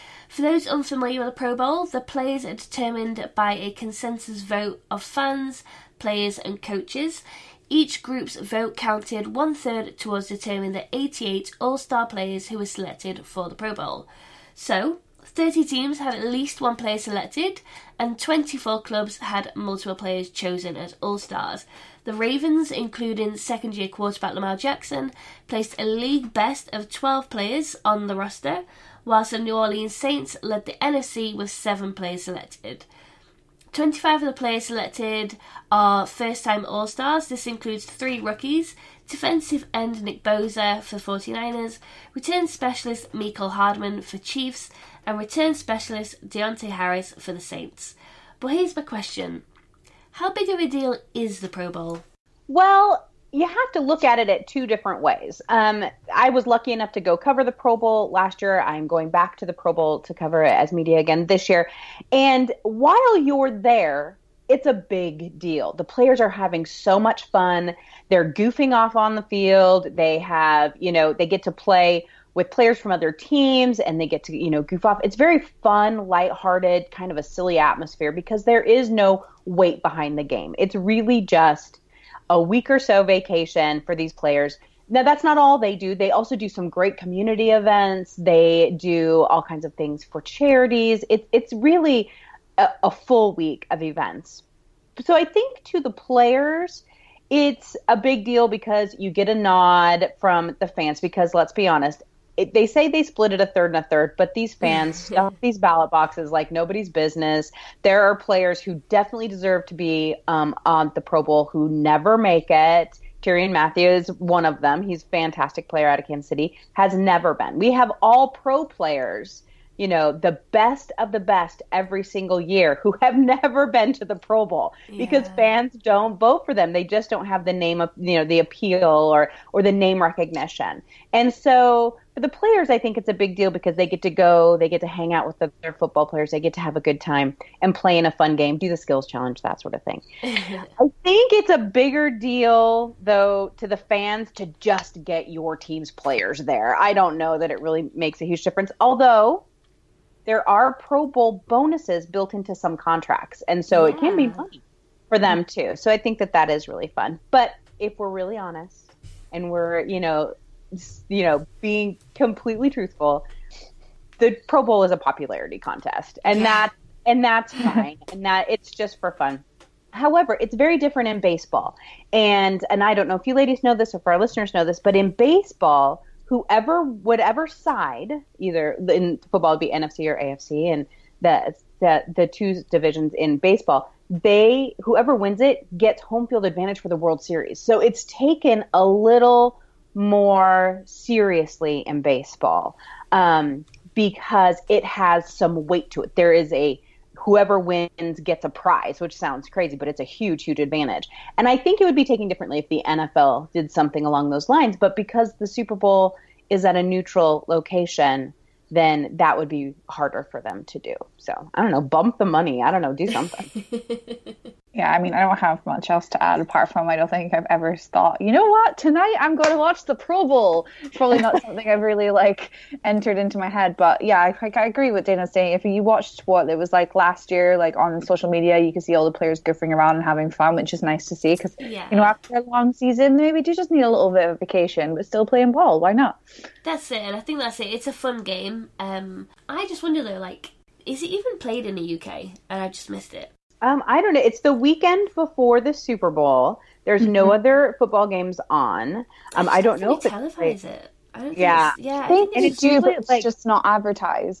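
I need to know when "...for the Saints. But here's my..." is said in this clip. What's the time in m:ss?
0:47.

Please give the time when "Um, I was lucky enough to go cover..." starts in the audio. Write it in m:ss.
0:55.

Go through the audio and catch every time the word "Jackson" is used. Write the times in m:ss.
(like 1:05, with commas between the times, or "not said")
0:24.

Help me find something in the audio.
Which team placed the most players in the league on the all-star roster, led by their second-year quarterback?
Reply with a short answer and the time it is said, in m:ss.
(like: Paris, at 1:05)
Ravens, at 0:22.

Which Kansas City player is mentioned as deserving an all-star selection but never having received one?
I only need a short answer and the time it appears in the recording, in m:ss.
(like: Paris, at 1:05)
Tyrann Mathieu, at 1:53.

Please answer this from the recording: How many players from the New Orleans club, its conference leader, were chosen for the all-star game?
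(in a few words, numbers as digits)
7.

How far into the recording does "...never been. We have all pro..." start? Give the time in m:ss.
1:56.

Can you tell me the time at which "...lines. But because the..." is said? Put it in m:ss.
3:24.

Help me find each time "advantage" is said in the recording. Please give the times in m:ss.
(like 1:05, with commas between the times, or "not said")
3:06, 3:20.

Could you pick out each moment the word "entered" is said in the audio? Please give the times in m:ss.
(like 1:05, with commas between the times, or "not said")
3:42.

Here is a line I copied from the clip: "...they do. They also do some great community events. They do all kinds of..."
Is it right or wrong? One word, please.
right.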